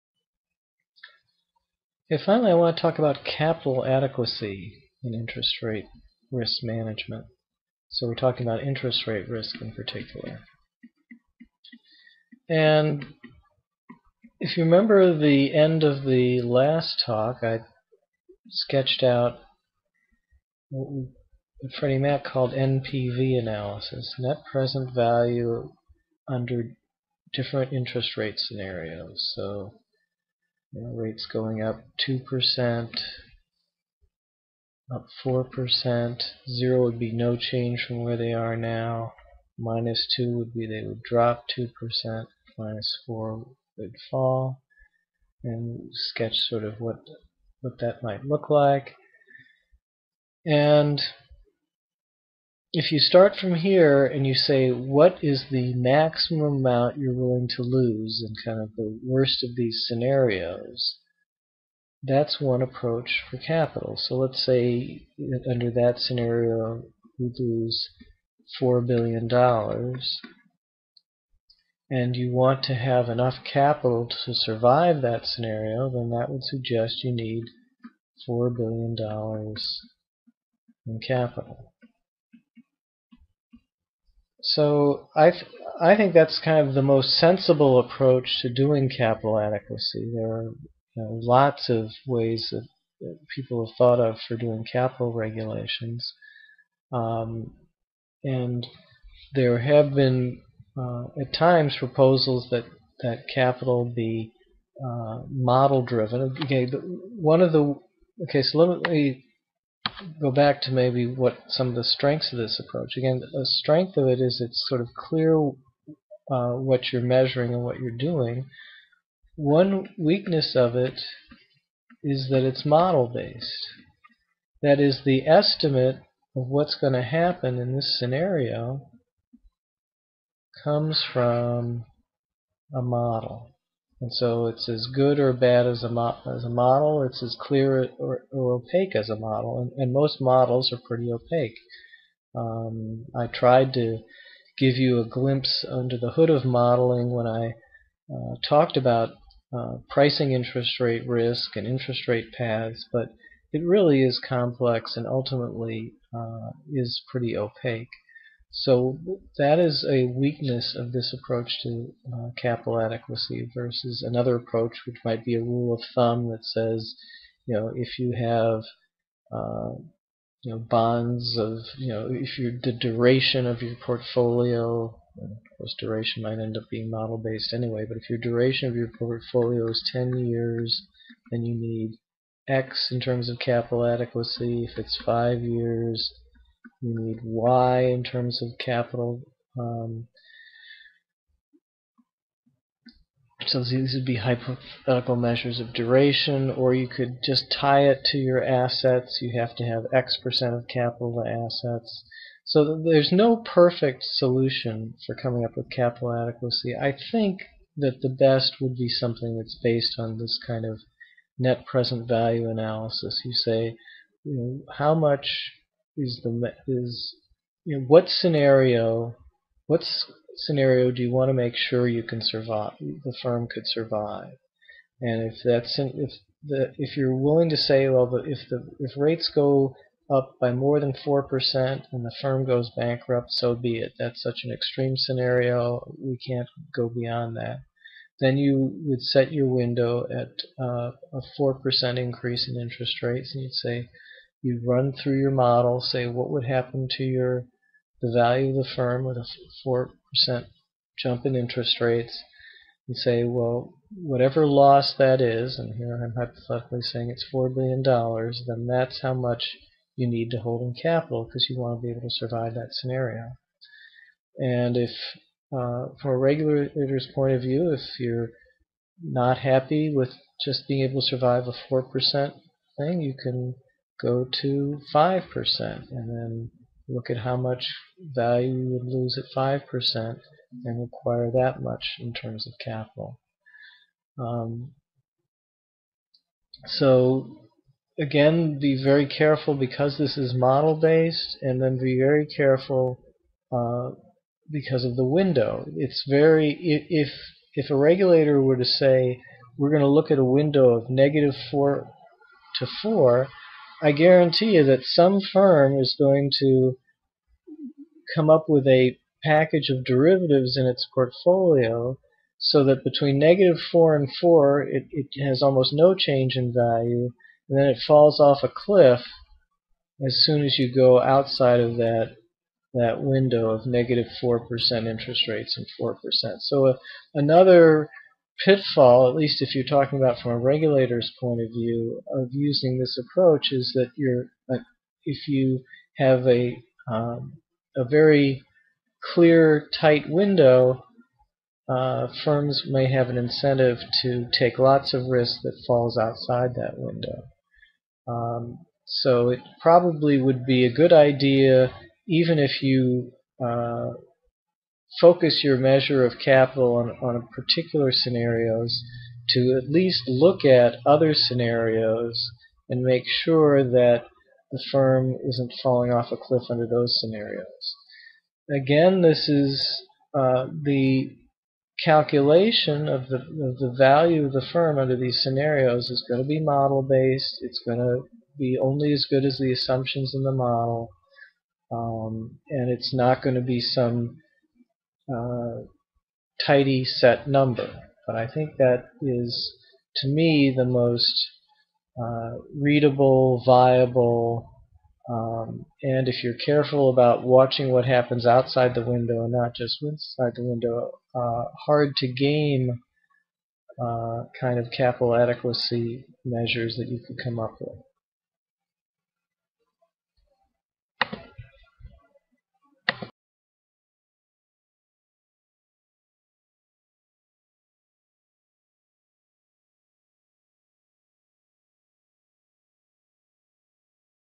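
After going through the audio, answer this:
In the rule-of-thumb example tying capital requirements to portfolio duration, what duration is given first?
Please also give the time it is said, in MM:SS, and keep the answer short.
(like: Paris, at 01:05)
10 years, at 02:59.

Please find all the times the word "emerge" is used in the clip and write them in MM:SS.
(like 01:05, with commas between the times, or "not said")
not said.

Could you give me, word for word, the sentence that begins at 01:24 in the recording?
So I th I think that's kind of the most sensible approach to doing capital adequacy.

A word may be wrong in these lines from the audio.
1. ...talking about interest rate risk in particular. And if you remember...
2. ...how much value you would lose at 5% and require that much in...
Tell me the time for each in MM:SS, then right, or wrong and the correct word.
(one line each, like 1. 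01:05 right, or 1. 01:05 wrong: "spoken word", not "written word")
1. 00:08 right
2. 04:37 right.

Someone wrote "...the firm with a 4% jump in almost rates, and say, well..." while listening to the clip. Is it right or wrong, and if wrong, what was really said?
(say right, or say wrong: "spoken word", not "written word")
wrong: "interest", not "almost".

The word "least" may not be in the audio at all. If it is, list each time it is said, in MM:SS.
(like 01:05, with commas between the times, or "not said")
05:29, 05:59.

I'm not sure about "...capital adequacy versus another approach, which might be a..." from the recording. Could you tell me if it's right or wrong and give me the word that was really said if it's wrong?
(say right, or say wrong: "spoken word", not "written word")
right.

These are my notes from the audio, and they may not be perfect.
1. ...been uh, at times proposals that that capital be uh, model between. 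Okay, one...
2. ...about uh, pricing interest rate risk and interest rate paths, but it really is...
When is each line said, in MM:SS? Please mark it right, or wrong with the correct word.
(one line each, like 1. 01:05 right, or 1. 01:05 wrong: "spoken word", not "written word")
1. 01:39 wrong: "driven", not "between"
2. 02:28 right.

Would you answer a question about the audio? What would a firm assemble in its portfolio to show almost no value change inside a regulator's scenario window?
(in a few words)
a package of derivatives.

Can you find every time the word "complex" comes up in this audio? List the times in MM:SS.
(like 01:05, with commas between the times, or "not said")
02:34.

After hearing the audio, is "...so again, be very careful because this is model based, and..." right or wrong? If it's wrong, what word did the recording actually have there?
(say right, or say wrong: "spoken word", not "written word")
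right.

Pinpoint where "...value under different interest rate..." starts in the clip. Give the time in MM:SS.
00:24.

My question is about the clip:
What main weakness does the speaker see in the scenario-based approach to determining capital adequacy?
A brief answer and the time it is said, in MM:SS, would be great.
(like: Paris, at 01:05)
model-based, at 02:02.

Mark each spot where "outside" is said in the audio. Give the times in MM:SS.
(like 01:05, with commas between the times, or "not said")
05:21, 05:45, 06:38.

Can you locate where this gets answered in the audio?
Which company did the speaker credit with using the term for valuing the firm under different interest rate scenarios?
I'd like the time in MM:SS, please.
00:21.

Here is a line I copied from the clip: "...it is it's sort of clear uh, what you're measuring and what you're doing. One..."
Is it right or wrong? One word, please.
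right.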